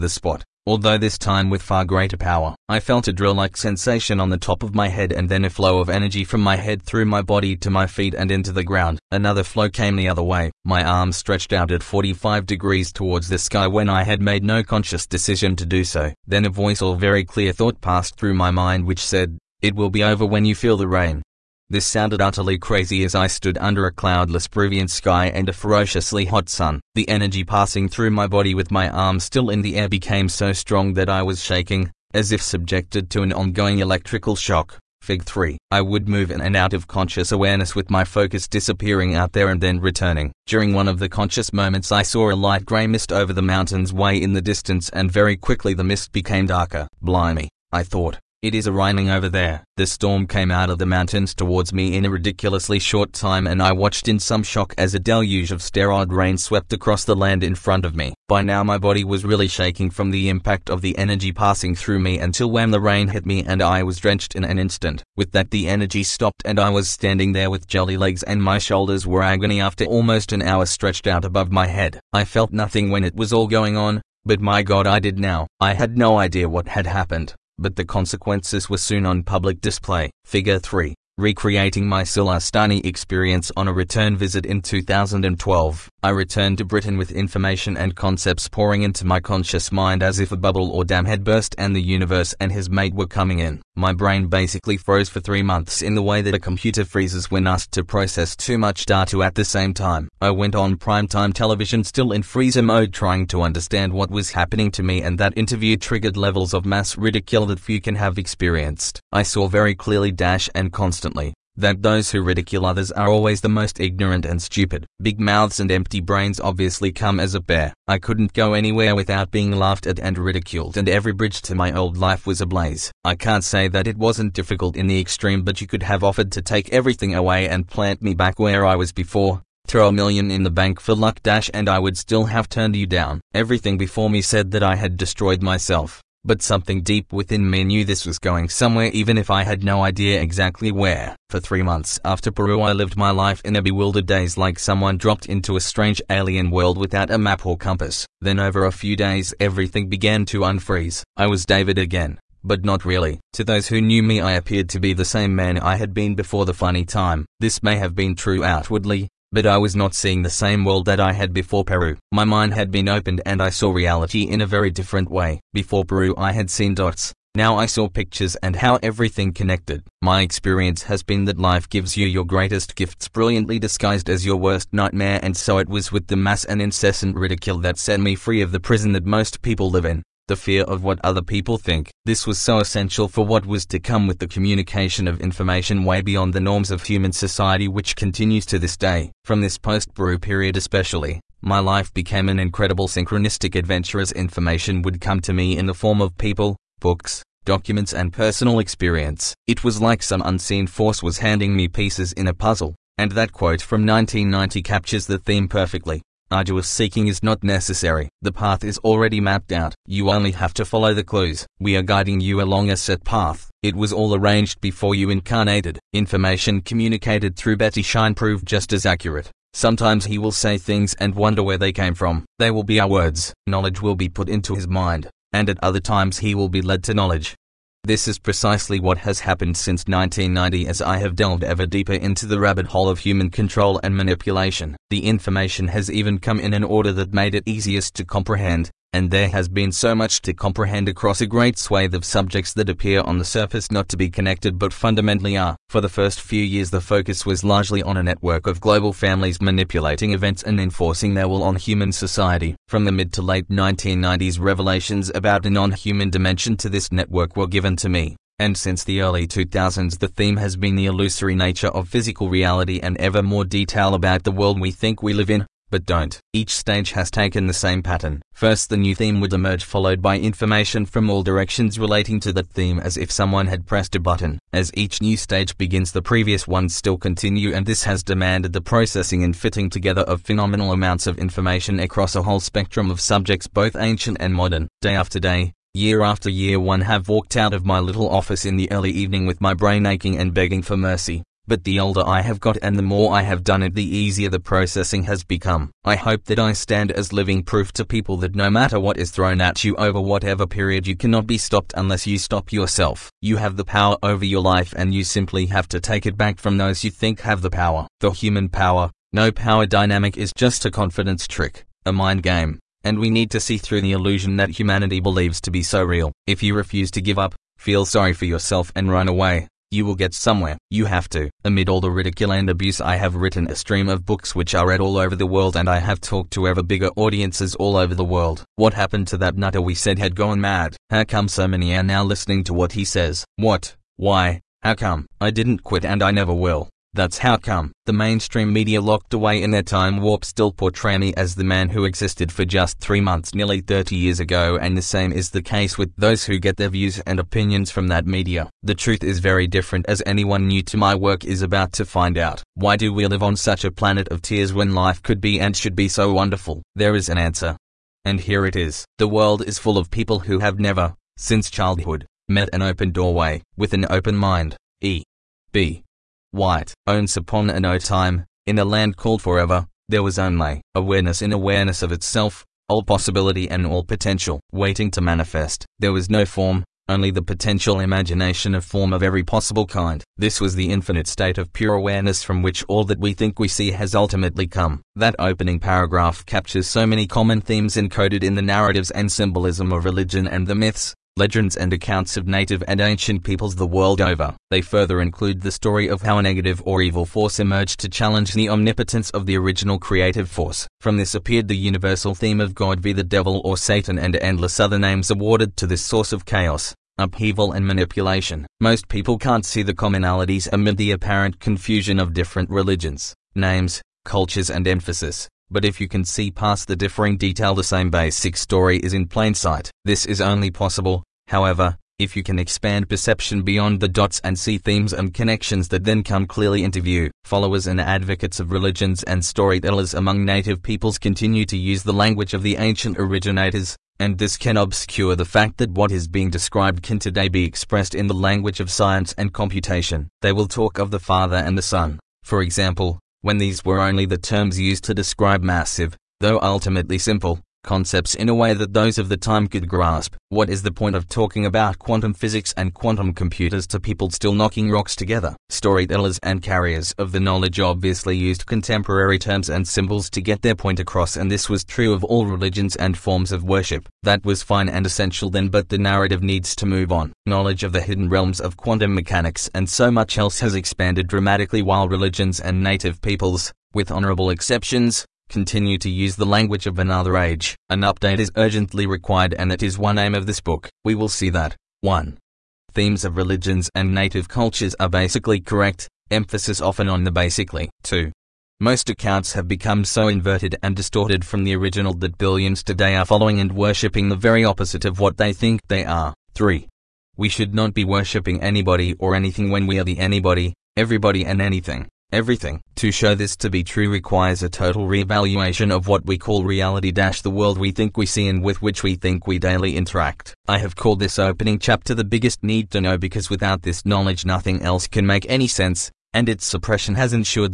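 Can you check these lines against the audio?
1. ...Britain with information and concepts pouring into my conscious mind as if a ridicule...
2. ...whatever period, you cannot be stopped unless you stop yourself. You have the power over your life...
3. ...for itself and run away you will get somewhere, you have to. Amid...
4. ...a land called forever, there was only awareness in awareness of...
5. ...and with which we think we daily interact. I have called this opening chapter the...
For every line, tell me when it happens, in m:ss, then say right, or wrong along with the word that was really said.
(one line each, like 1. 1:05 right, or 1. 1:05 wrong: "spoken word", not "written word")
1. 1:26 wrong: "bubble", not "ridicule"
2. 5:00 right
3. 5:18 wrong: "yourself", not "itself"
4. 6:08 right
5. 8:28 right.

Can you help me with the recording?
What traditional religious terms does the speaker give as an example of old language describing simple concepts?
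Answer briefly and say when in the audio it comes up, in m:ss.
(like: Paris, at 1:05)
the Father and the Son, at 7:20.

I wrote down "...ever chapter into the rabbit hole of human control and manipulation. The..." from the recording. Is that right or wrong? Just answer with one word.
wrong.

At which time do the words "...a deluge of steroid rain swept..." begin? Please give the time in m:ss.
0:54.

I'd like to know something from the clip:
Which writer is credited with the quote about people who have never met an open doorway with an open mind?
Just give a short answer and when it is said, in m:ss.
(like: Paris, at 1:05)
E. B. White, at 6:04.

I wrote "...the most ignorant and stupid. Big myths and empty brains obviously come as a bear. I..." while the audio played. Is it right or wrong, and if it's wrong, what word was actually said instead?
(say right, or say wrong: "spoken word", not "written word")
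wrong: "mouths", not "myths".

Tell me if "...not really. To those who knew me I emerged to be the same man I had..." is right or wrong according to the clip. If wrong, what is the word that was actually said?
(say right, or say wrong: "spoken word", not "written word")
wrong: "appeared", not "emerged".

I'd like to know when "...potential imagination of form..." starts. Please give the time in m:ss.
6:17.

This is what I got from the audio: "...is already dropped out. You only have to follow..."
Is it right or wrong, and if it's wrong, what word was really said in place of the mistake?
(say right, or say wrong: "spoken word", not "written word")
wrong: "mapped", not "dropped".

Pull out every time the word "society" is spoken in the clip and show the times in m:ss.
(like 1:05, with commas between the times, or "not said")
3:07, 4:11.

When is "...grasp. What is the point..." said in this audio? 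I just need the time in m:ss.
7:29.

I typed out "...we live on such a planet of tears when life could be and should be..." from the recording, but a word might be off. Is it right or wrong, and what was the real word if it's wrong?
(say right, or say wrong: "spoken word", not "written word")
right.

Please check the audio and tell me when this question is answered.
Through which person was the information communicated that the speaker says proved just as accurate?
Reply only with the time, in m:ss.
3:37.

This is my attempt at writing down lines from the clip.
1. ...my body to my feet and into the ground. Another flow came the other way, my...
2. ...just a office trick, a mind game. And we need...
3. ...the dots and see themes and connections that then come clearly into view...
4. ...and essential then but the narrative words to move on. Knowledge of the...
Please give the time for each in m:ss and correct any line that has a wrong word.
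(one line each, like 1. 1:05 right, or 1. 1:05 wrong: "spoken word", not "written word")
1. 0:07 right
2. 5:10 wrong: "confidence", not "office"
3. 7:03 right
4. 7:44 wrong: "needs", not "words".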